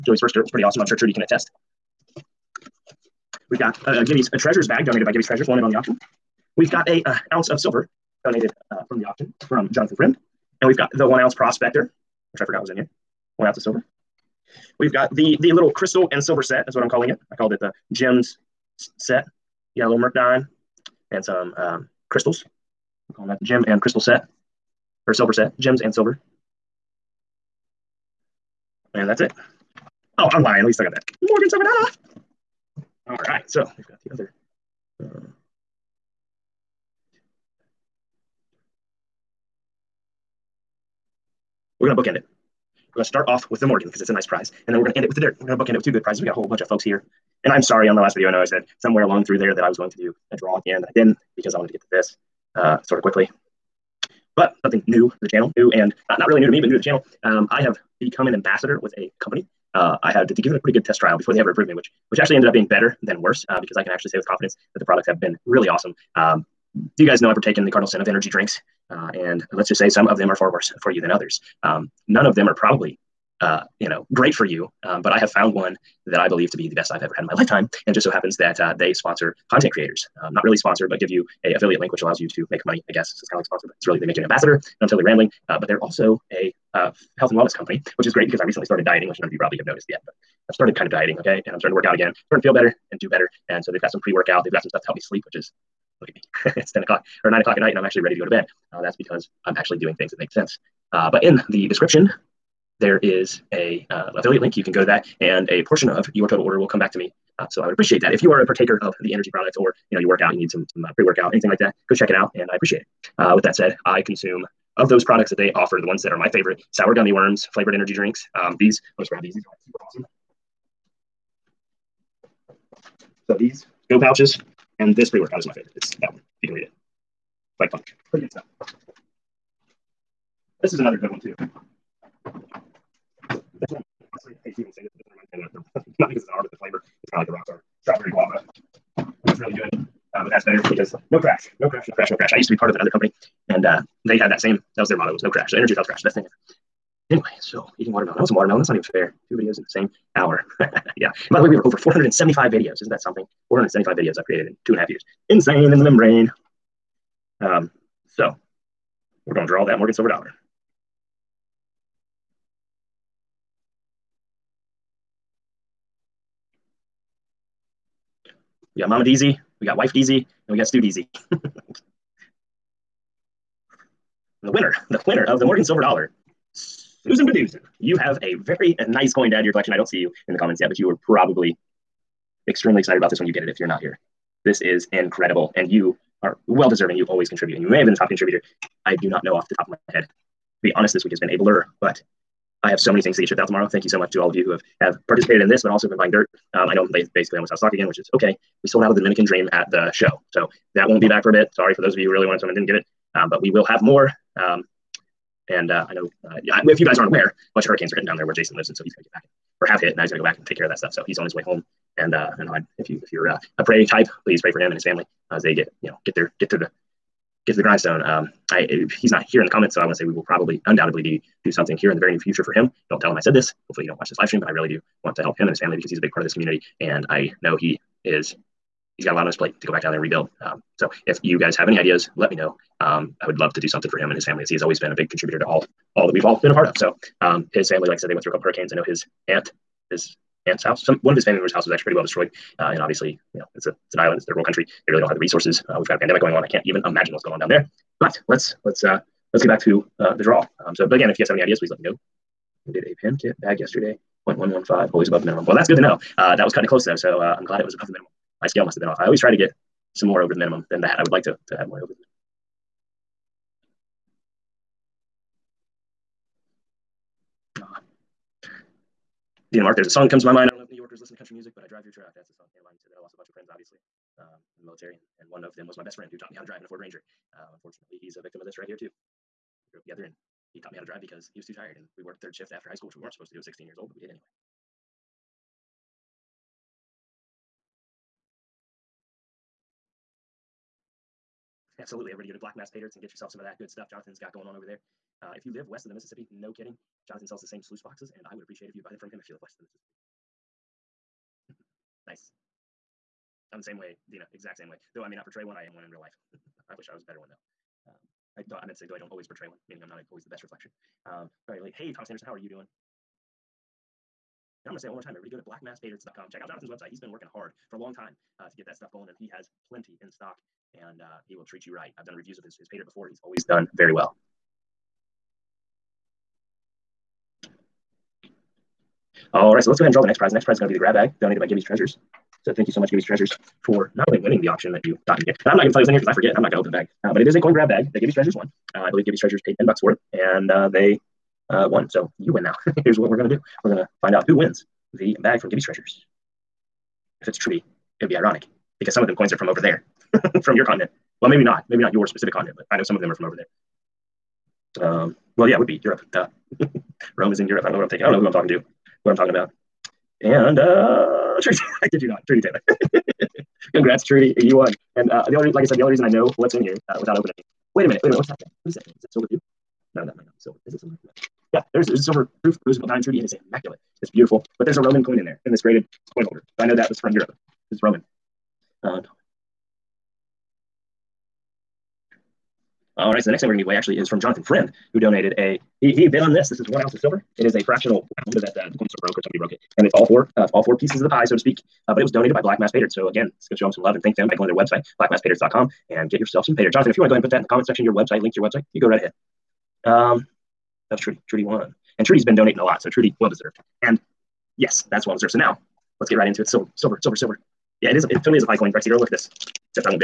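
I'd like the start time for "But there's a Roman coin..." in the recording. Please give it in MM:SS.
06:14.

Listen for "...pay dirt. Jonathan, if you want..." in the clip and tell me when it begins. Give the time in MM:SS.
06:36.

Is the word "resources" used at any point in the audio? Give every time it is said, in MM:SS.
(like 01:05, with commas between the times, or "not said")
04:05.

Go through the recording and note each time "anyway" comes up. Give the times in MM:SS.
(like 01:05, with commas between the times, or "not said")
02:27, 04:44.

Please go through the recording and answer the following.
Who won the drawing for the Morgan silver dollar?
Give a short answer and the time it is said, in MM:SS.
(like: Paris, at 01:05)
Susan Bedoozin, at 02:56.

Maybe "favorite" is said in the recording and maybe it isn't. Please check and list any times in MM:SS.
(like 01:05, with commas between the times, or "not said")
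01:56, 02:05.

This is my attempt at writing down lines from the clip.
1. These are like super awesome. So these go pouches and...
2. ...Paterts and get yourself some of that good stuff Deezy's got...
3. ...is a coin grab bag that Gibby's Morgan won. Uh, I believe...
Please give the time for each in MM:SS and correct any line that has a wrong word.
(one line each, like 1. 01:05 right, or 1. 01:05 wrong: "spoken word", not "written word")
1. 01:59 right
2. 04:52 wrong: "Jonathan", not "Deezy"
3. 05:37 wrong: "Treasures", not "Morgan".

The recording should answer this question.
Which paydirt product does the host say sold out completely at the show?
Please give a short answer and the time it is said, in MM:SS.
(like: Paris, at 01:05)
Dominican Dream, at 03:18.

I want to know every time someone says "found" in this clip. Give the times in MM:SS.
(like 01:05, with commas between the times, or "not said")
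01:15.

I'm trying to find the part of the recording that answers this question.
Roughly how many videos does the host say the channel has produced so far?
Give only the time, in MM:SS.
02:31.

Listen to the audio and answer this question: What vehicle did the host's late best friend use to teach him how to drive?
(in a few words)
Ford Ranger.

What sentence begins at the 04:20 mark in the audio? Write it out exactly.
I would like to to have more over the minimum.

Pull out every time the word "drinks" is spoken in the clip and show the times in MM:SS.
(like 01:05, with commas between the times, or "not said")
01:08, 01:57.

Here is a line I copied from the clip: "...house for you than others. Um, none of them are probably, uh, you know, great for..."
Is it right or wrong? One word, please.
wrong.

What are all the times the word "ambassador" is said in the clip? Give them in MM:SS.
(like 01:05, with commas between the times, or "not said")
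00:58, 01:24.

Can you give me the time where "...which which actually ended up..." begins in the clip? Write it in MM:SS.
01:01.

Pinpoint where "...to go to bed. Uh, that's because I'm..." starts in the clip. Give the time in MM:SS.
01:38.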